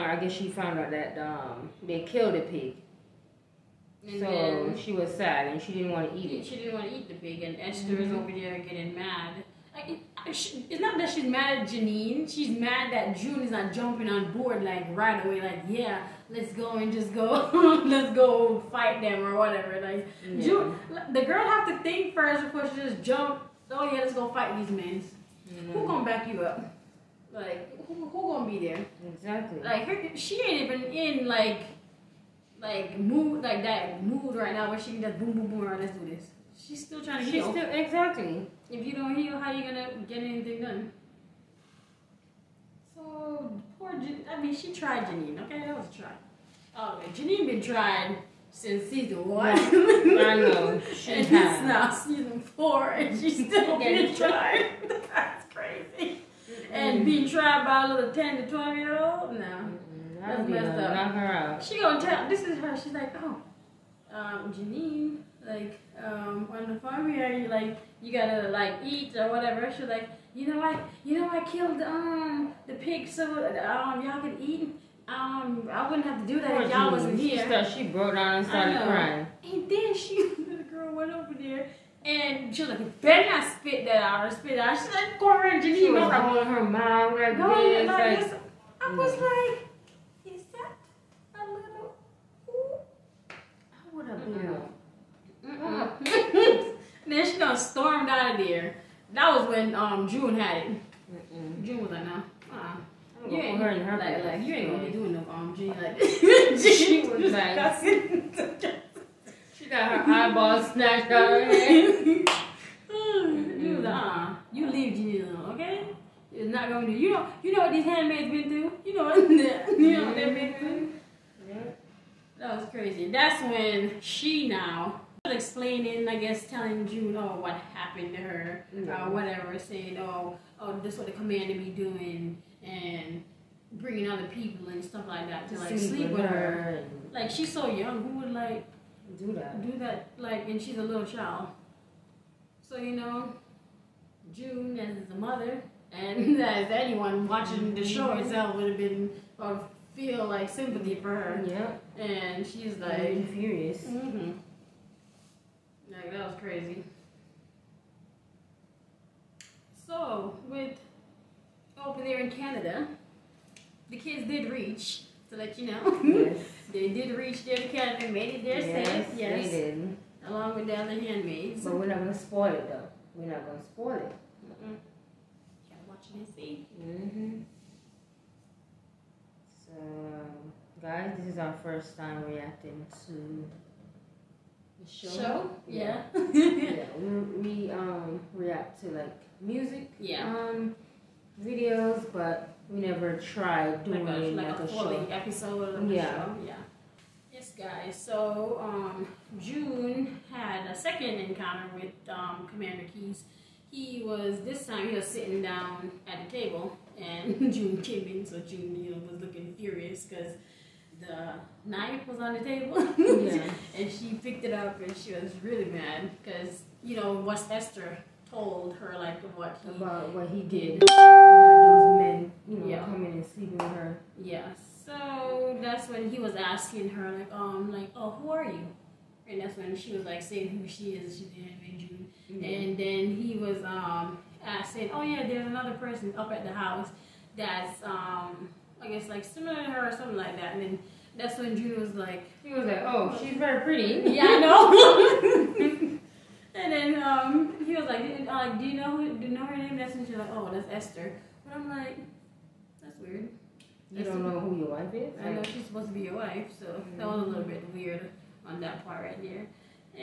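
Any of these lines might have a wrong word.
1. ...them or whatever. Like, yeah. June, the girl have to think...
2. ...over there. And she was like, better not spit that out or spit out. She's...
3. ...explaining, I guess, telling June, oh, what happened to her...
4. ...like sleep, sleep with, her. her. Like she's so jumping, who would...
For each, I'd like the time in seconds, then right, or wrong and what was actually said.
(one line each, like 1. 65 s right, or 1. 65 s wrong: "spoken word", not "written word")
1. 19 s right
2. 81 s right
3. 125 s right
4. 135 s wrong: "young", not "jumping".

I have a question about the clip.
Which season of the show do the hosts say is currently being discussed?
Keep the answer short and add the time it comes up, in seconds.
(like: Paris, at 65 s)
Season 4, at 51 s.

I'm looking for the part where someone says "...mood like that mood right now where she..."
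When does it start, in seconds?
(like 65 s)
32 s.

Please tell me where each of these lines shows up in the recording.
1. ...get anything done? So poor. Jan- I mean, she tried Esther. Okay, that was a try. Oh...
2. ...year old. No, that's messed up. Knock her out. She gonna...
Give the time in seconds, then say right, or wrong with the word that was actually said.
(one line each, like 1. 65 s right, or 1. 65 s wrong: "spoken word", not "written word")
1. 40 s wrong: "Janine", not "Esther"
2. 58 s right.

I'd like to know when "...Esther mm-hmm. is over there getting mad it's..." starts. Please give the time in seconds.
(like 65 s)
7 s.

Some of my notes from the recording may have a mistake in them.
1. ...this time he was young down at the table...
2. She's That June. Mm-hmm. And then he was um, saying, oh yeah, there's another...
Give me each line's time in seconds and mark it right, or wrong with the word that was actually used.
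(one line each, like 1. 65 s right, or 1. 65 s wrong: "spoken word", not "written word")
1. 204 s wrong: "sitting", not "young"
2. 231 s wrong: "Anime", not "That".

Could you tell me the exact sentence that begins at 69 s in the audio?
She's like, you know, I you know I killed um the pig so um y'all can eat.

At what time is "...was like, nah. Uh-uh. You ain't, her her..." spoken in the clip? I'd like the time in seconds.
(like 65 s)
101 s.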